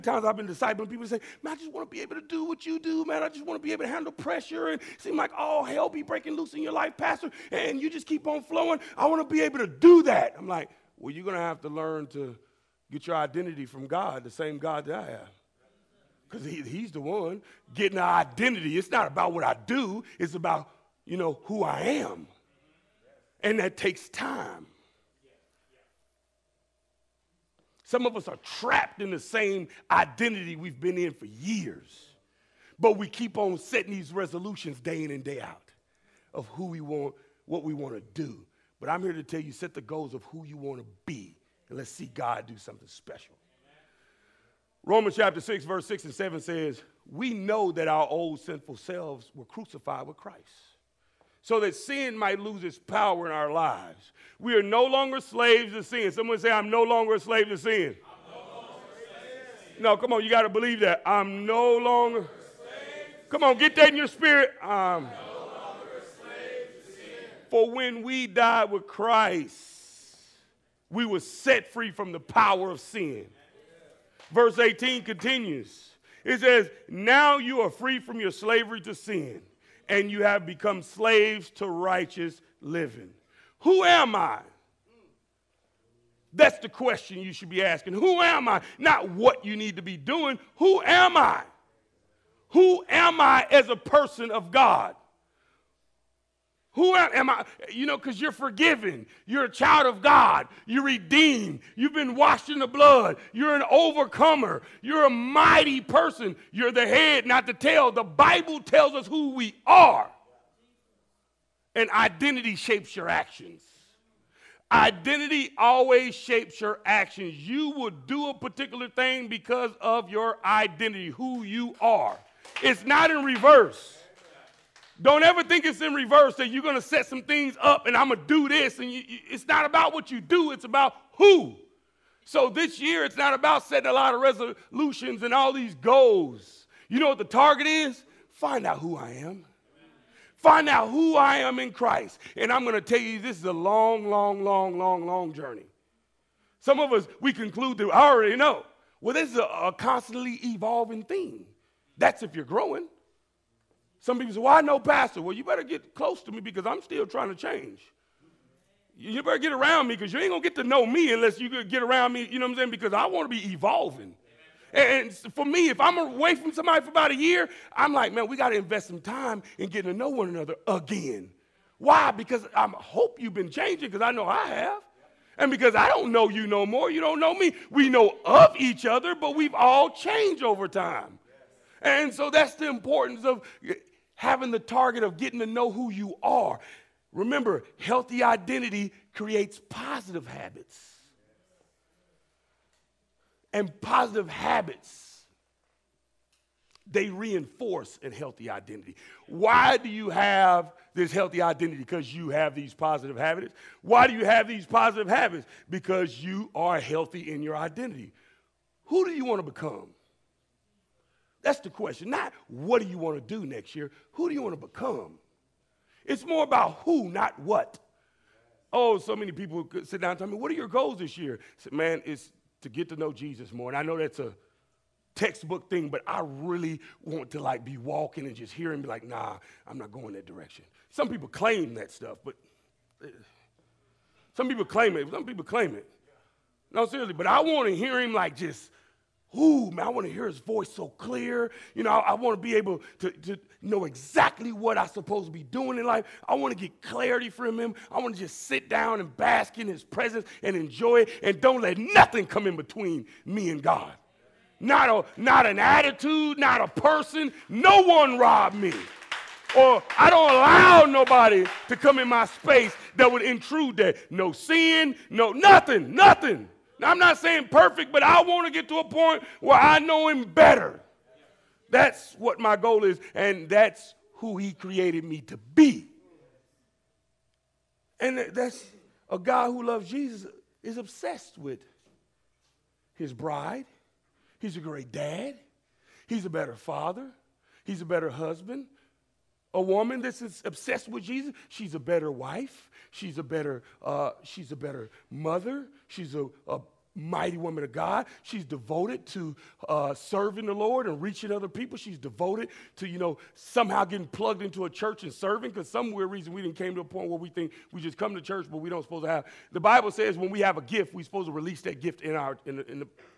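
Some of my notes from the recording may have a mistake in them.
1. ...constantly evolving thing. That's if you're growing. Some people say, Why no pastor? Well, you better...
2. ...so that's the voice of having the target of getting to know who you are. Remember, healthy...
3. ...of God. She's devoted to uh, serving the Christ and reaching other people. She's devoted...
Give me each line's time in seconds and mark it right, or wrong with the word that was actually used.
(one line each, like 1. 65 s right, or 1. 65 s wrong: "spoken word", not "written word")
1. 149 s right
2. 182 s wrong: "importance", not "voice"
3. 297 s wrong: "Lord", not "Christ".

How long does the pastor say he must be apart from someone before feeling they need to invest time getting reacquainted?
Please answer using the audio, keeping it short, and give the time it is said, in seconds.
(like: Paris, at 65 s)
a year, at 166 s.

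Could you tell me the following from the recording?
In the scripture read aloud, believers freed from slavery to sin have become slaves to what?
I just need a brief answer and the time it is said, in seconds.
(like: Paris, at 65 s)
righteous living, at 81 s.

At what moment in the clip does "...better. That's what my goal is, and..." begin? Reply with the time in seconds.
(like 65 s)
270 s.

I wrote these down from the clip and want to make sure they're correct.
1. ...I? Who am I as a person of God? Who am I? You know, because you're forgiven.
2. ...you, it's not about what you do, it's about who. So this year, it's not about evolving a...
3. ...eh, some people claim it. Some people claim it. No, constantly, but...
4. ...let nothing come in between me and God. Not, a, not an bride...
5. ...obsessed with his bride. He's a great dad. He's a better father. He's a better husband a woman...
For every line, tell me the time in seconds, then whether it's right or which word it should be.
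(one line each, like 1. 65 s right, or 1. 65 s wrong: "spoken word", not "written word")
1. 91 s right
2. 128 s wrong: "setting", not "evolving"
3. 233 s wrong: "seriously", not "constantly"
4. 251 s wrong: "attitude", not "bride"
5. 280 s right.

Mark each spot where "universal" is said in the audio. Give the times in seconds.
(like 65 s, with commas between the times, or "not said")
not said.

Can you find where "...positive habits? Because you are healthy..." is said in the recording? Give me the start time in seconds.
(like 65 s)
204 s.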